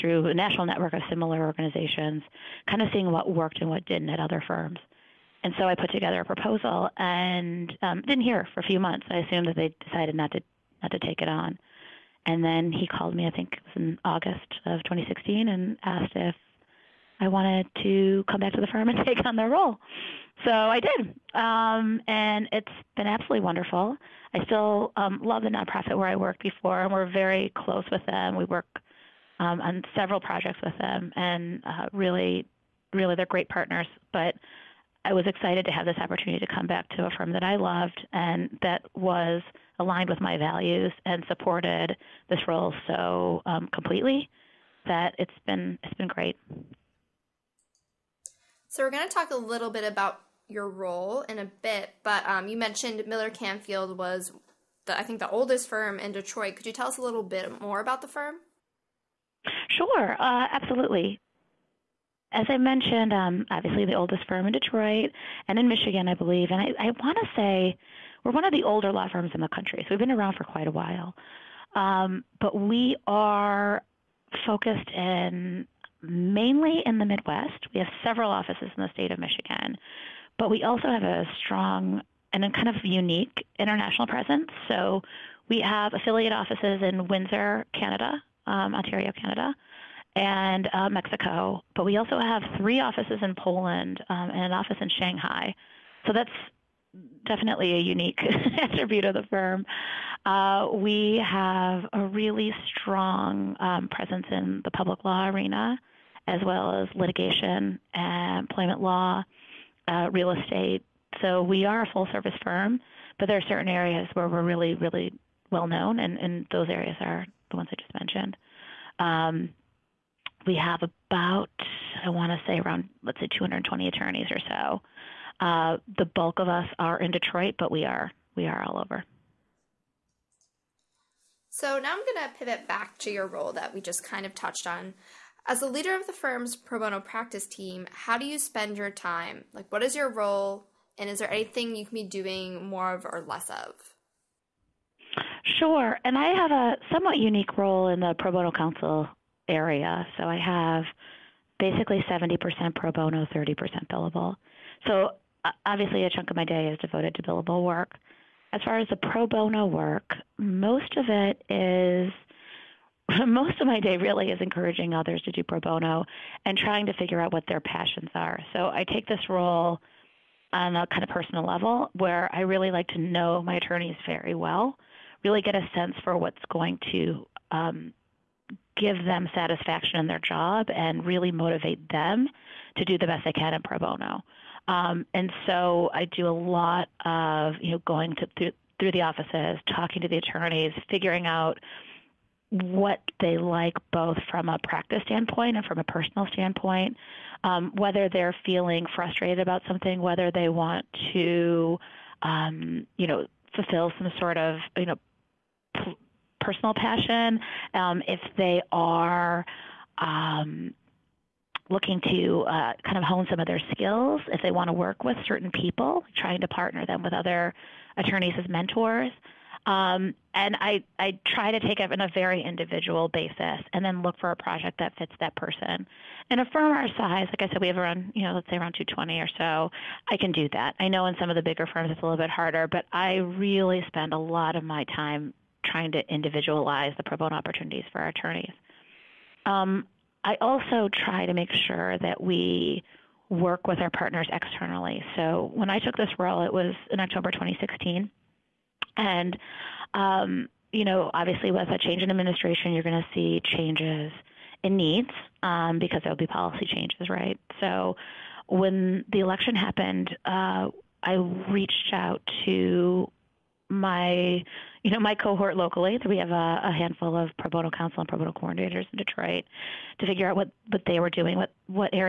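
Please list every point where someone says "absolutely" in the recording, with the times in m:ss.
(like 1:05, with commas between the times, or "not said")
0:23, 1:00.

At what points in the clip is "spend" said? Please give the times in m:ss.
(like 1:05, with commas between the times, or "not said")
2:18, 3:53.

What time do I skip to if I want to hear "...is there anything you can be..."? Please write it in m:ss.
2:21.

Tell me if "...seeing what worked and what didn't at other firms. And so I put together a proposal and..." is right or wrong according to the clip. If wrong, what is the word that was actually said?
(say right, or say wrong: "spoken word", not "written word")
right.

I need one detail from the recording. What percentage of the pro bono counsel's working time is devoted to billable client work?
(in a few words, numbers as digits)
30%.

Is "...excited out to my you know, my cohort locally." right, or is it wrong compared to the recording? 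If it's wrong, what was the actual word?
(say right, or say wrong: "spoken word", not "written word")
wrong: "reached", not "excited".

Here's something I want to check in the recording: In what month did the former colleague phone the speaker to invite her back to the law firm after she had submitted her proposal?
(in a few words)
August.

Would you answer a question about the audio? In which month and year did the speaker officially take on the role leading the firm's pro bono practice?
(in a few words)
October 2016.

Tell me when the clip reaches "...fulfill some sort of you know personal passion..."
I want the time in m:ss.
3:23.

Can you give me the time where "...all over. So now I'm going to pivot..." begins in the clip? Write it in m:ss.
2:08.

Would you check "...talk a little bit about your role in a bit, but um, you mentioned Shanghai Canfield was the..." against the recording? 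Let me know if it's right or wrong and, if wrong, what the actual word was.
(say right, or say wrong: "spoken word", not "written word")
wrong: "Miller", not "Shanghai".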